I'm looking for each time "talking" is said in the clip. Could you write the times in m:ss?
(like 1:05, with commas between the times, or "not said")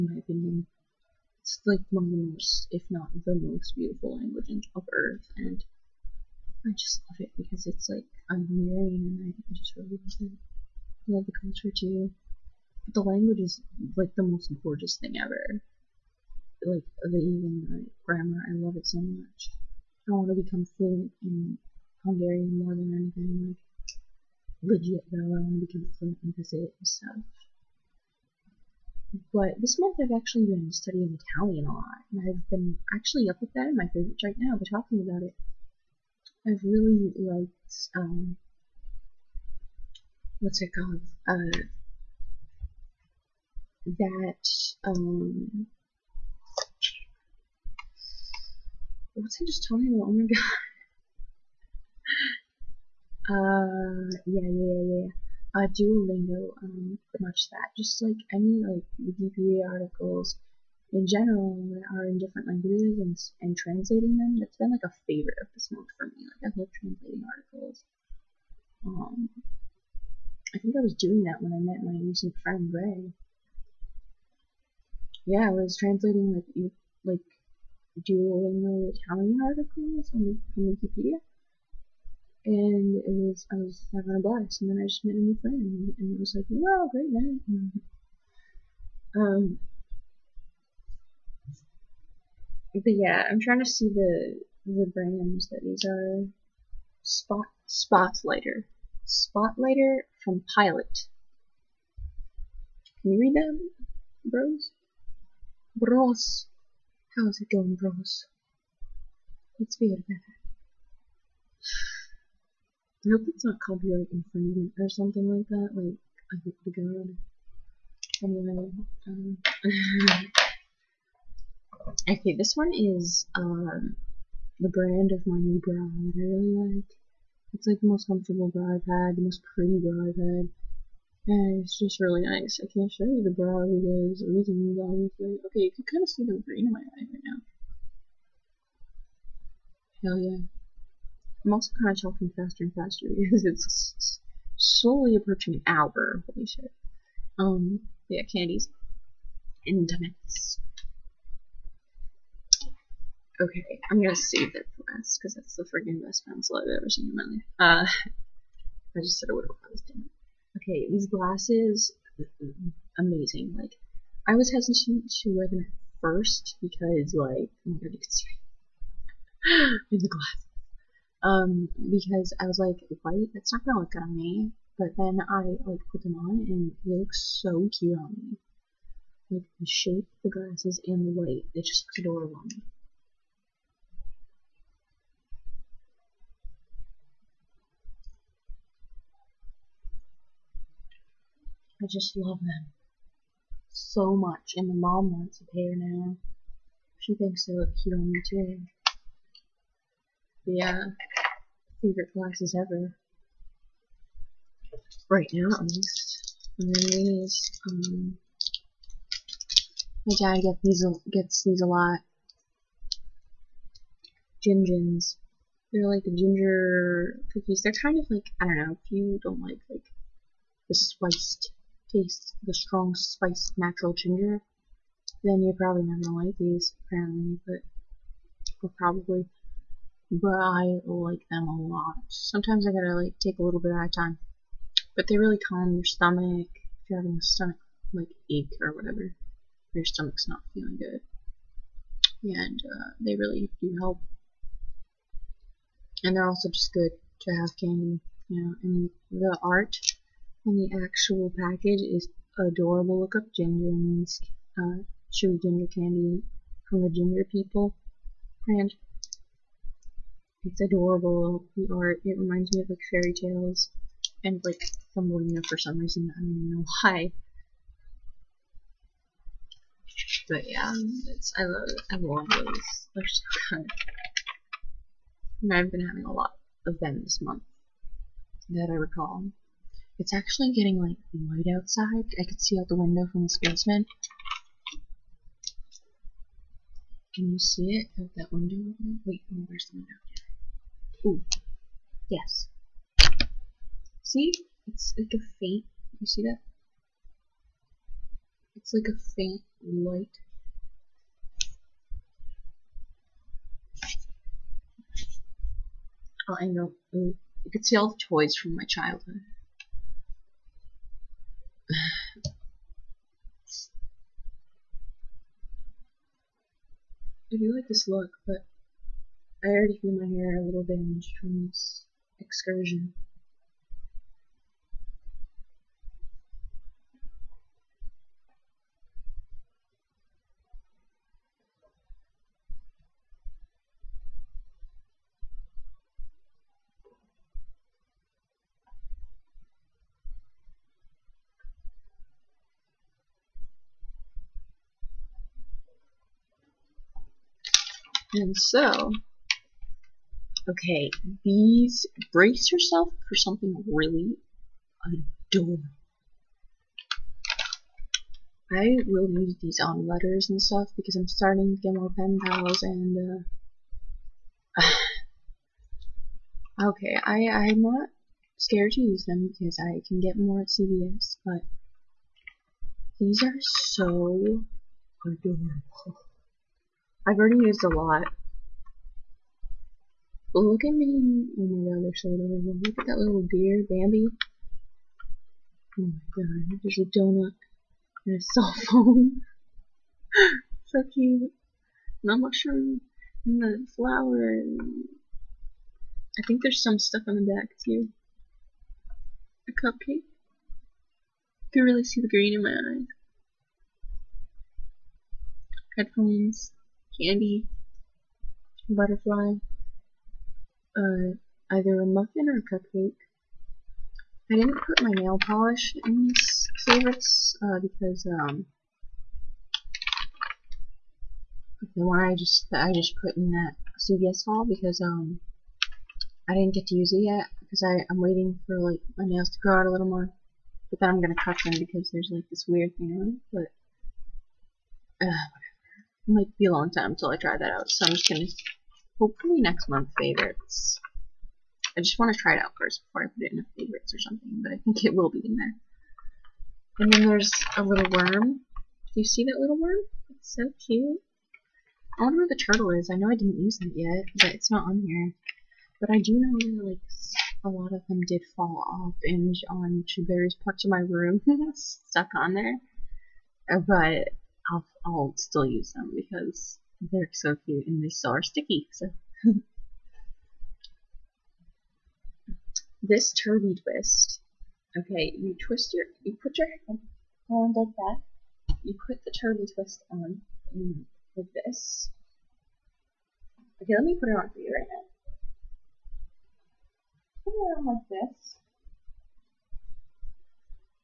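0:34, 0:49, 2:22.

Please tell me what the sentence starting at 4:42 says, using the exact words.
I could see out the window from this basement.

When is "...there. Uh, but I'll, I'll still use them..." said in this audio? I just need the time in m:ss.
7:42.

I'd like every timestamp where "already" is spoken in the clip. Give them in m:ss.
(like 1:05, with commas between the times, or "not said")
5:19, 6:17.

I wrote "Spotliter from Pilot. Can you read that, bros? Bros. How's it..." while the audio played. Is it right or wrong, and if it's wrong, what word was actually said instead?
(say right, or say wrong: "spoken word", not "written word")
right.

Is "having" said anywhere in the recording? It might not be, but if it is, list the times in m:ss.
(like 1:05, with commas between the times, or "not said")
1:23, 3:56, 4:35.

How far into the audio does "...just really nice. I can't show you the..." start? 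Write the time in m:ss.
2:11.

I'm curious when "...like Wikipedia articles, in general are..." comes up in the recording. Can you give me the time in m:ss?
0:58.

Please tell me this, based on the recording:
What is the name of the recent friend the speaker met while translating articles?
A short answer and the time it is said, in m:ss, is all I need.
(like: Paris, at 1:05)
Rei, at 1:12.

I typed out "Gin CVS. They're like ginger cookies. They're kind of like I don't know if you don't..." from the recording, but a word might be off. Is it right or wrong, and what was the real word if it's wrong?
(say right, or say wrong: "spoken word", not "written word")
wrong: "Gins", not "CVS".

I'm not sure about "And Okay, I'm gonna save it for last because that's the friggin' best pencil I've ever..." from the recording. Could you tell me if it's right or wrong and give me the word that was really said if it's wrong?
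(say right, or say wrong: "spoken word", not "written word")
right.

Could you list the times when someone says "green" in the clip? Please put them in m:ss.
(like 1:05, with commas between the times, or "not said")
2:16, 6:42.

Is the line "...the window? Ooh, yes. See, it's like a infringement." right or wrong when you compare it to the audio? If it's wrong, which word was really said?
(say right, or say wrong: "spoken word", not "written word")
wrong: "faint", not "infringement".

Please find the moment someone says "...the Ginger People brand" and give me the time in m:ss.
4:16.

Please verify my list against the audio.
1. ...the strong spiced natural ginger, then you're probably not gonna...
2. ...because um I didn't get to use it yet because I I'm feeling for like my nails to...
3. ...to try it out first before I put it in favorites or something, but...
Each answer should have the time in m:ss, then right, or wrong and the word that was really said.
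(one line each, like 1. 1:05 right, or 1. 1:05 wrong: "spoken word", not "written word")
1. 3:42 right
2. 7:04 wrong: "waiting", not "feeling"
3. 7:22 right.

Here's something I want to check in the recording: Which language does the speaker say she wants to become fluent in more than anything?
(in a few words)
Hungarian.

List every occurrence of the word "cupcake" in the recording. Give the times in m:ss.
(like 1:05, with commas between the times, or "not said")
6:39, 6:52.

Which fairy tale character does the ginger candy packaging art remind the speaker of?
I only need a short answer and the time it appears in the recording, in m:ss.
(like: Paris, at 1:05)
Thumbelina, at 4:24.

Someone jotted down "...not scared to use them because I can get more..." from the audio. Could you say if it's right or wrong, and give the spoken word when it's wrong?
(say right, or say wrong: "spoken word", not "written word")
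right.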